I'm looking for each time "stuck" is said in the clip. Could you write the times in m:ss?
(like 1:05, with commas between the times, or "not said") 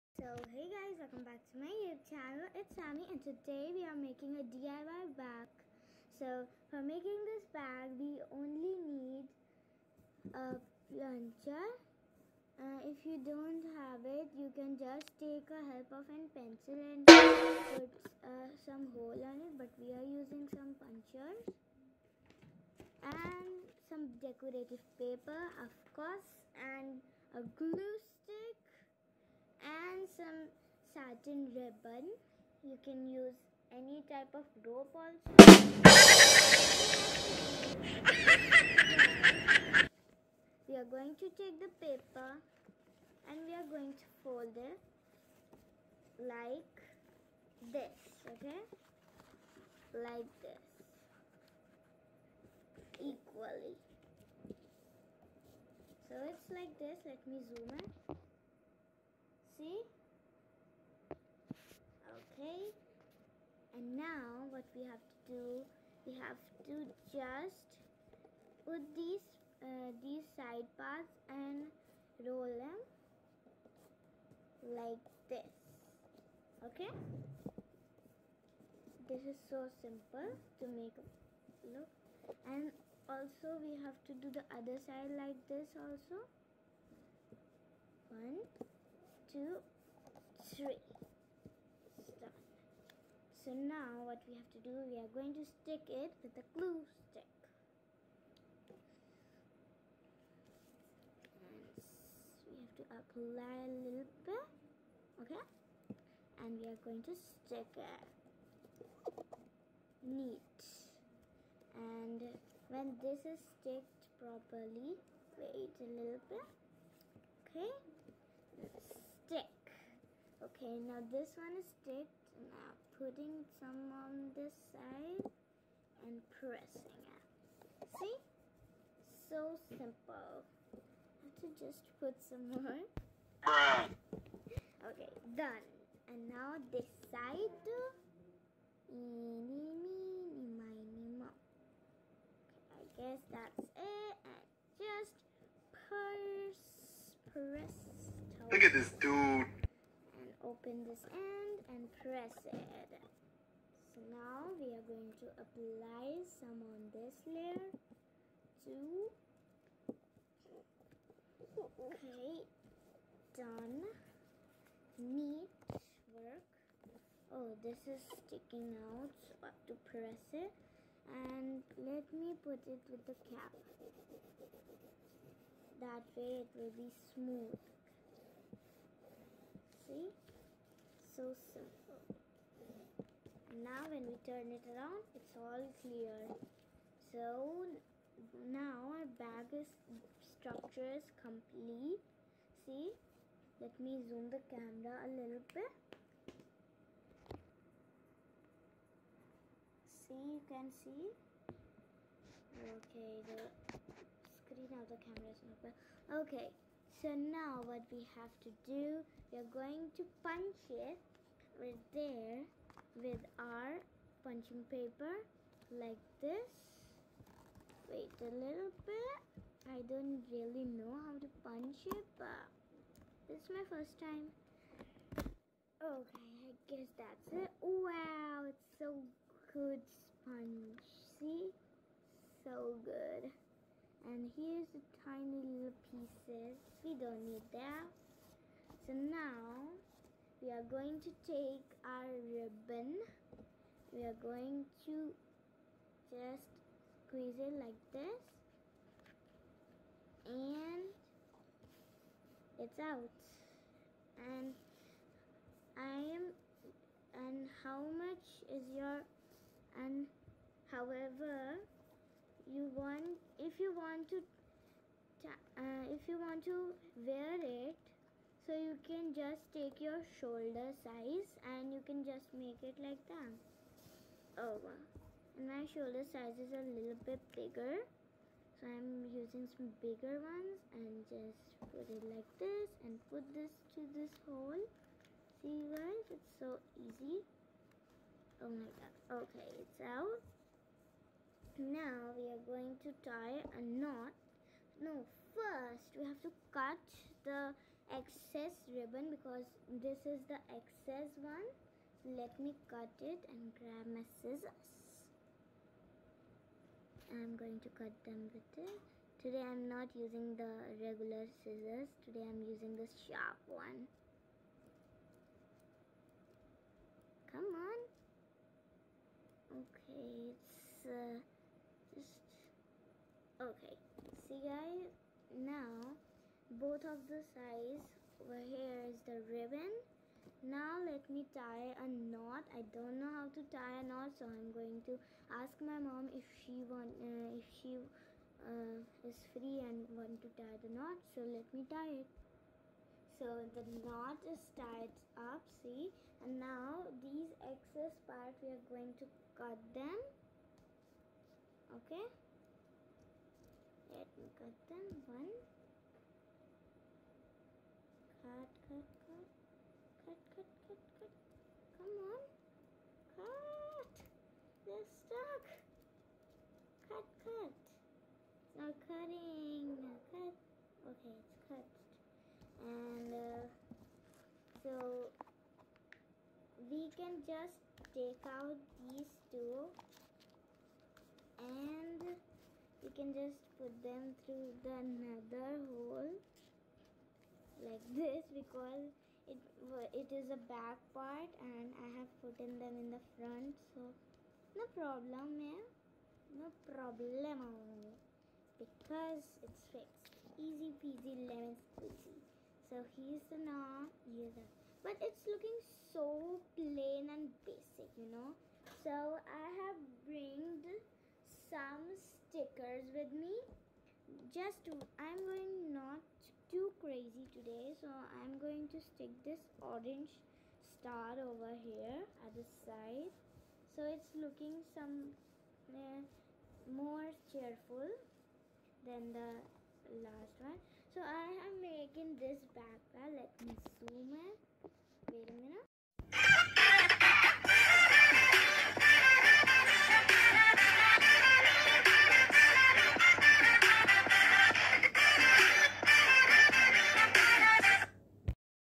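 2:01, 6:04.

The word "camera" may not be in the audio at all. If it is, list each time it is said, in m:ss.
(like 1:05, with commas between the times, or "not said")
3:14, 3:25.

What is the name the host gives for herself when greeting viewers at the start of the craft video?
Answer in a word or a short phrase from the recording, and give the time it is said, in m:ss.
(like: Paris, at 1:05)
Shamy, at 0:02.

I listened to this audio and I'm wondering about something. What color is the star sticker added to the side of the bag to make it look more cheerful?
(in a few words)
orange.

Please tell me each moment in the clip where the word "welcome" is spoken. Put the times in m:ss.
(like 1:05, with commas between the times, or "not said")
0:01.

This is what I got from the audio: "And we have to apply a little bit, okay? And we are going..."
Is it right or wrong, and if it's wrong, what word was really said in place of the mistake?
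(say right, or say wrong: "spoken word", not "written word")
right.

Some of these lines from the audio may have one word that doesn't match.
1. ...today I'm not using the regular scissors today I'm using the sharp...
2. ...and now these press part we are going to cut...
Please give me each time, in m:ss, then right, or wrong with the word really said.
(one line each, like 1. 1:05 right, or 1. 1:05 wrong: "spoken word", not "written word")
1. 5:09 right
2. 5:46 wrong: "excess", not "press".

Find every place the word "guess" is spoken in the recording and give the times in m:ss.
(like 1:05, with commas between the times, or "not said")
2:23, 3:46.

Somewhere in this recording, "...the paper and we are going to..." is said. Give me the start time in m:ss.
0:41.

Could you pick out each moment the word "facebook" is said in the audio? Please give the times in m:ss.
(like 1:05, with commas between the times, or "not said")
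not said.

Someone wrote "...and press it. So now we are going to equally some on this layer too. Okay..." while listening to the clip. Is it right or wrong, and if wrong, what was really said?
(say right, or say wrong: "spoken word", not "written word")
wrong: "apply", not "equally".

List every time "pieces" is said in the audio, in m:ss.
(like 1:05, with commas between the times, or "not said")
3:55.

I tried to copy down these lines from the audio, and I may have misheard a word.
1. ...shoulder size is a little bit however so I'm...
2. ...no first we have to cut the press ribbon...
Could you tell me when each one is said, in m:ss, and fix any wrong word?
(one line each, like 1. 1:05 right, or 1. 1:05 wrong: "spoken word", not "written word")
1. 4:35 wrong: "bigger", not "however"
2. 4:54 wrong: "excess", not "press".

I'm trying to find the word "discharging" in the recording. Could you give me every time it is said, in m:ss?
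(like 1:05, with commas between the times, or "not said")
not said.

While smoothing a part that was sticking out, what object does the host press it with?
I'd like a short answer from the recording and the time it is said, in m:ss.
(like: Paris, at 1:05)
the cap, at 2:53.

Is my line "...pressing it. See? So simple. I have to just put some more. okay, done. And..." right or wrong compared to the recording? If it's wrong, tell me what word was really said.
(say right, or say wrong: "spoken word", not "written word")
right.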